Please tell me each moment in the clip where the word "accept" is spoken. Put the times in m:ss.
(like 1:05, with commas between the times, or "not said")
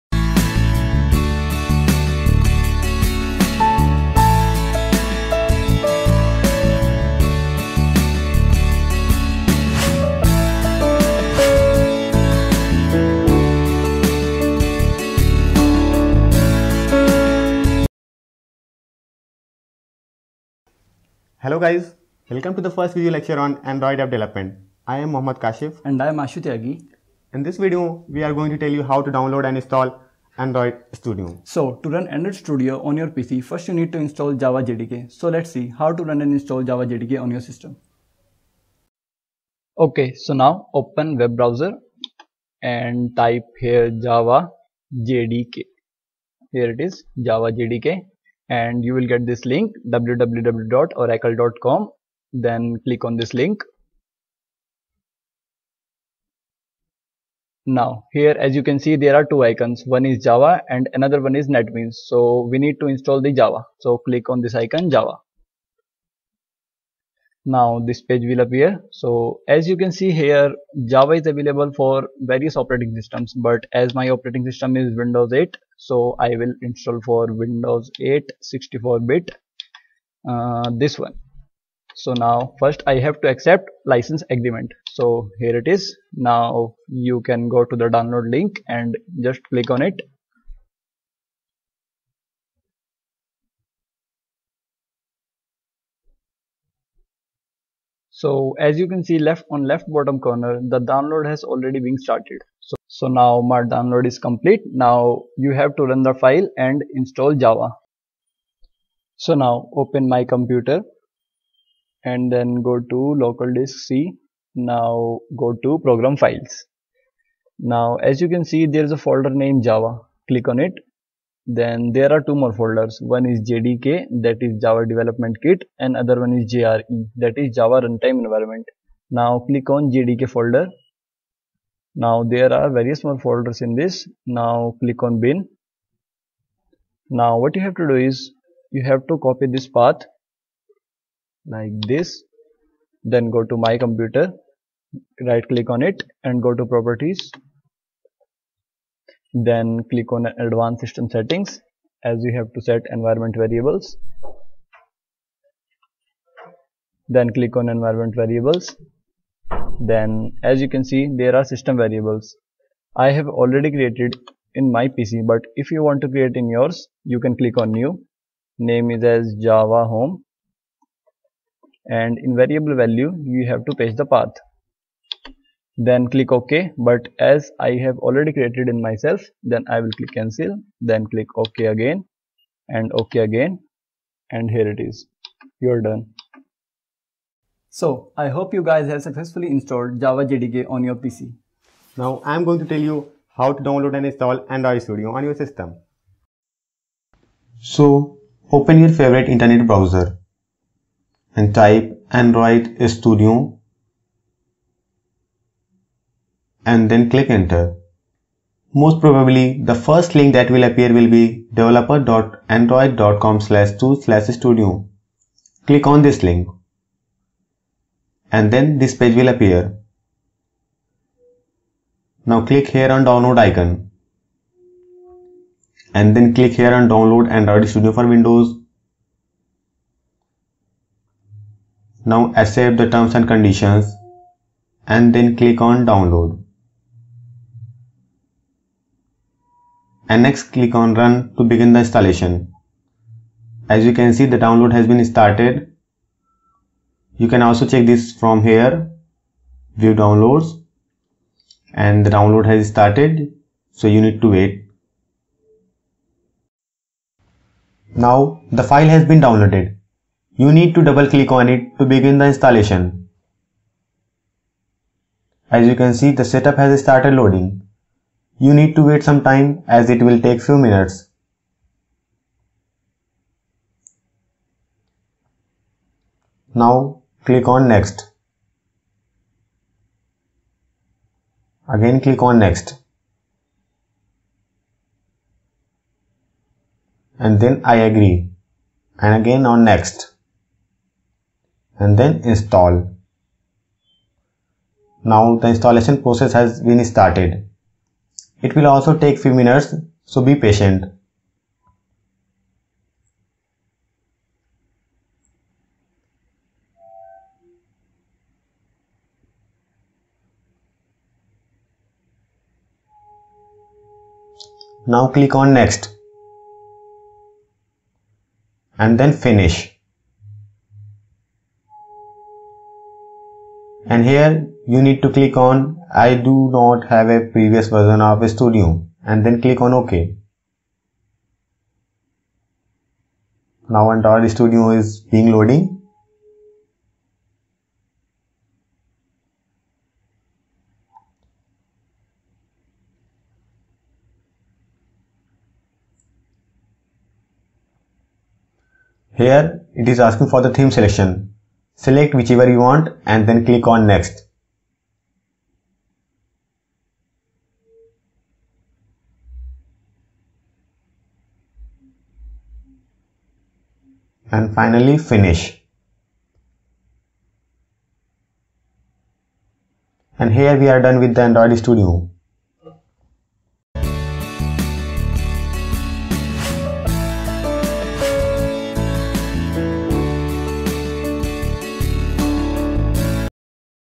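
1:23, 3:52.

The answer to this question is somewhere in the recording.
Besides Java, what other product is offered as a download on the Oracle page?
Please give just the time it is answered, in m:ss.
1:01.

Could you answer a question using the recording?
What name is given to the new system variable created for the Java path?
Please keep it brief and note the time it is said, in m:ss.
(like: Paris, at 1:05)
java home, at 2:49.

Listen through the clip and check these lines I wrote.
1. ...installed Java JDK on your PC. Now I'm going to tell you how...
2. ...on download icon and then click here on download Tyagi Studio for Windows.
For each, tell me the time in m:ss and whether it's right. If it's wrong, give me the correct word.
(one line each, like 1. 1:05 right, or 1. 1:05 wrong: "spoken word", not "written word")
1. 3:09 right
2. 3:42 wrong: "Android", not "Tyagi".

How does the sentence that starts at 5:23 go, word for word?
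And here you need to click on I do not have a previous version of Studio and then click on OK.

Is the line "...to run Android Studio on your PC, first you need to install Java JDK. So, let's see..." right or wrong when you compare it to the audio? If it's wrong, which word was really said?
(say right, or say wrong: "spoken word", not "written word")
right.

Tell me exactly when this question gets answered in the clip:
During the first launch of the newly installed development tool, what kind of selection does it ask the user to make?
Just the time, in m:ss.
5:50.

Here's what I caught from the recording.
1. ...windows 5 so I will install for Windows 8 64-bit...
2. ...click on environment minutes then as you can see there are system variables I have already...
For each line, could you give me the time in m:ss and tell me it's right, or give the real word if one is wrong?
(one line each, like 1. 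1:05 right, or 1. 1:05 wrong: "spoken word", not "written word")
1. 1:15 wrong: "8", not "5"
2. 2:37 wrong: "variables", not "minutes".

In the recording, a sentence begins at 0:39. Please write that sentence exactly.
Okay, so now open web browser and type here Java JDK.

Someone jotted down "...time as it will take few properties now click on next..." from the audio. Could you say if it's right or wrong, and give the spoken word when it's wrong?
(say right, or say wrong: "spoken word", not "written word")
wrong: "minutes", not "properties".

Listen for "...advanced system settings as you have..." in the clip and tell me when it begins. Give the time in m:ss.
2:30.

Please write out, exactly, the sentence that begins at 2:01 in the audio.
Then there are two more folders.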